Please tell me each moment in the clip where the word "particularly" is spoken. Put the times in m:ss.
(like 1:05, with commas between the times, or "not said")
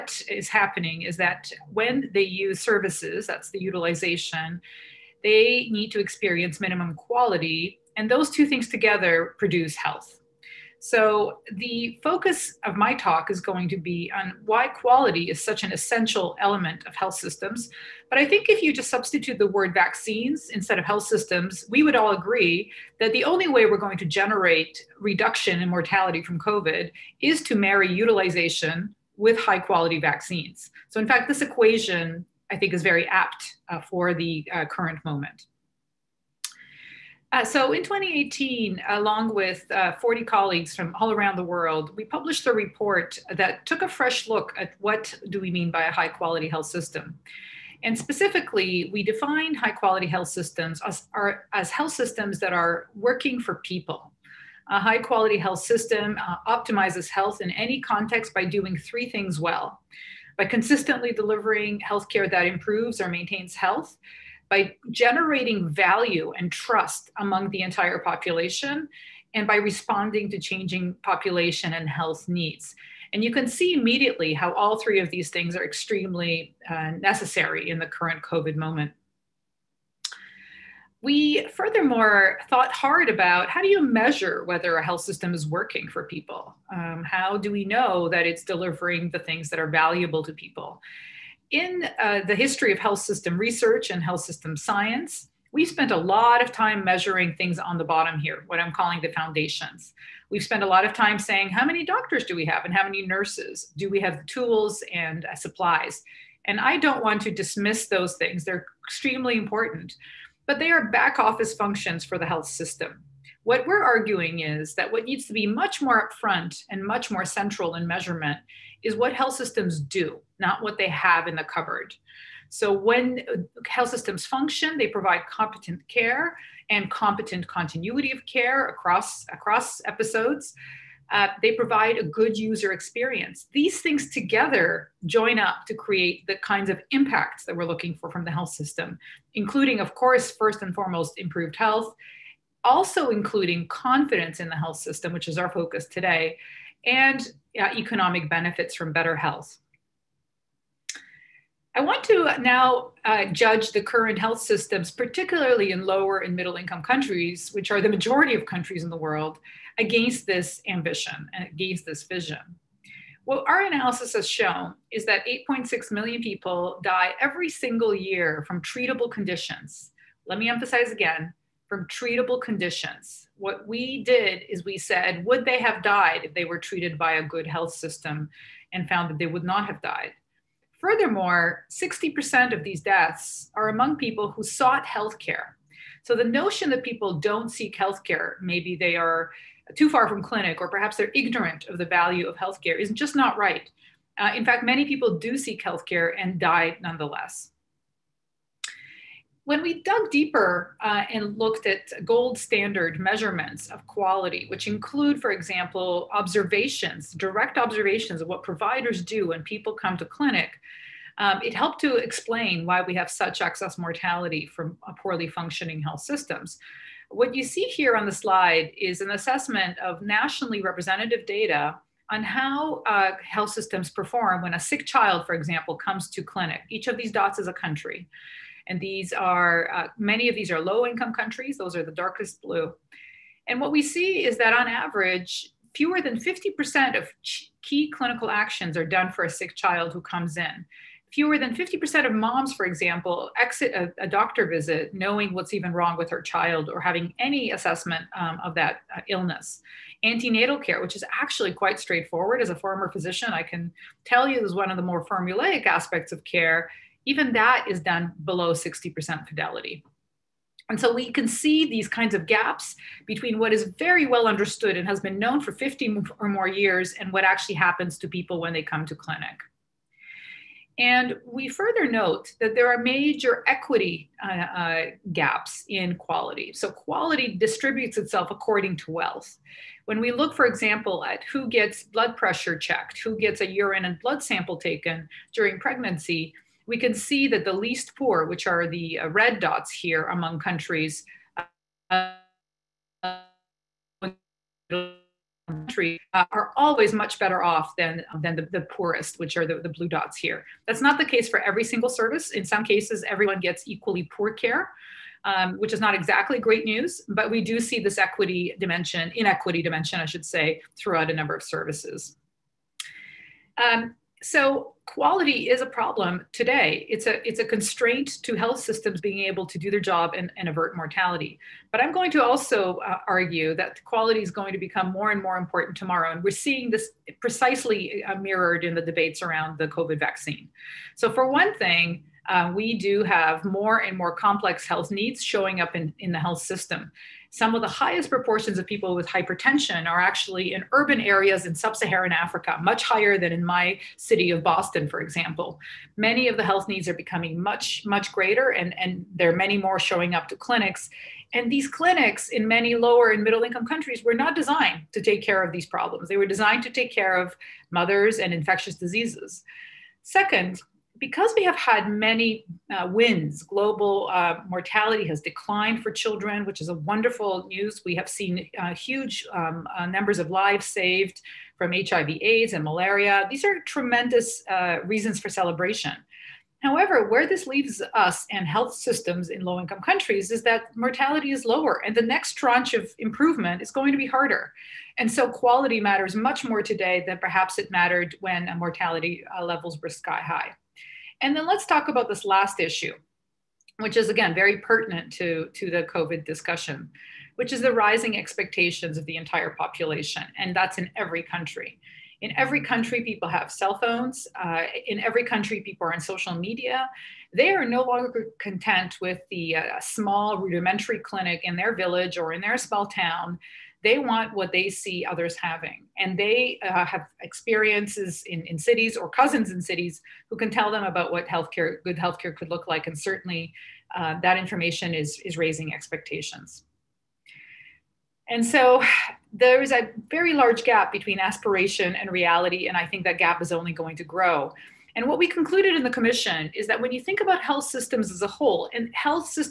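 2:34.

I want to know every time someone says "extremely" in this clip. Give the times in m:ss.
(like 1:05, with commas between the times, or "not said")
1:15, 1:48.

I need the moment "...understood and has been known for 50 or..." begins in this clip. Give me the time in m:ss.
4:24.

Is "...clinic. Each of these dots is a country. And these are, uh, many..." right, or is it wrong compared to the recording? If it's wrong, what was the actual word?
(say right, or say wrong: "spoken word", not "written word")
right.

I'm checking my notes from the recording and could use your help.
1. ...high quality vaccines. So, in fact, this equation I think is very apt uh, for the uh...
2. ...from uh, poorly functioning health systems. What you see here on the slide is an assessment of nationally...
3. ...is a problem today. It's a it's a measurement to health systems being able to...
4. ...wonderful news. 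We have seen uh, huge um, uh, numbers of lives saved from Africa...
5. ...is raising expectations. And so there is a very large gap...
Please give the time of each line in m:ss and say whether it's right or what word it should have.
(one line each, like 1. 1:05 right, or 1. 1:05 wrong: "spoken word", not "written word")
1. 0:29 right
2. 3:34 right
3. 5:15 wrong: "constraint", not "measurement"
4. 6:06 wrong: "HIV", not "Africa"
5. 7:05 right.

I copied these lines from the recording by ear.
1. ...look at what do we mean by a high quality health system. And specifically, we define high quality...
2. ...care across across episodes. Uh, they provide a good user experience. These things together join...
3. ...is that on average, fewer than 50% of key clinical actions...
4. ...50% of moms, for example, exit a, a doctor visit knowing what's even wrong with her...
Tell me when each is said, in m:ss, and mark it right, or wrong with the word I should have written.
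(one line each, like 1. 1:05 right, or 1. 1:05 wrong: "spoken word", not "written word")
1. 0:44 right
2. 2:08 right
3. 3:54 right
4. 4:01 right.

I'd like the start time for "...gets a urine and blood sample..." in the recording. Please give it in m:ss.
4:43.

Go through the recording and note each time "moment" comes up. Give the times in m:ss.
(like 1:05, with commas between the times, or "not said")
0:35, 1:18.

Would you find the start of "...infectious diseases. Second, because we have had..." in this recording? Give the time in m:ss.
5:58.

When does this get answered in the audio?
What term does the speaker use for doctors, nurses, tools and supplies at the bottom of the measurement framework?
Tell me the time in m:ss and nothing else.
1:39.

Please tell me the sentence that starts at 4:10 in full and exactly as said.
Antenatal care, which is actually quite straightforward.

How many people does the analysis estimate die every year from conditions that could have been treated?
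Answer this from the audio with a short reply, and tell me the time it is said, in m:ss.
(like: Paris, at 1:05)
8.6 million, at 2:45.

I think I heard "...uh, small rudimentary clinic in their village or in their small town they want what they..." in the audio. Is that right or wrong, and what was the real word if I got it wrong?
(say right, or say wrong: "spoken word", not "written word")
right.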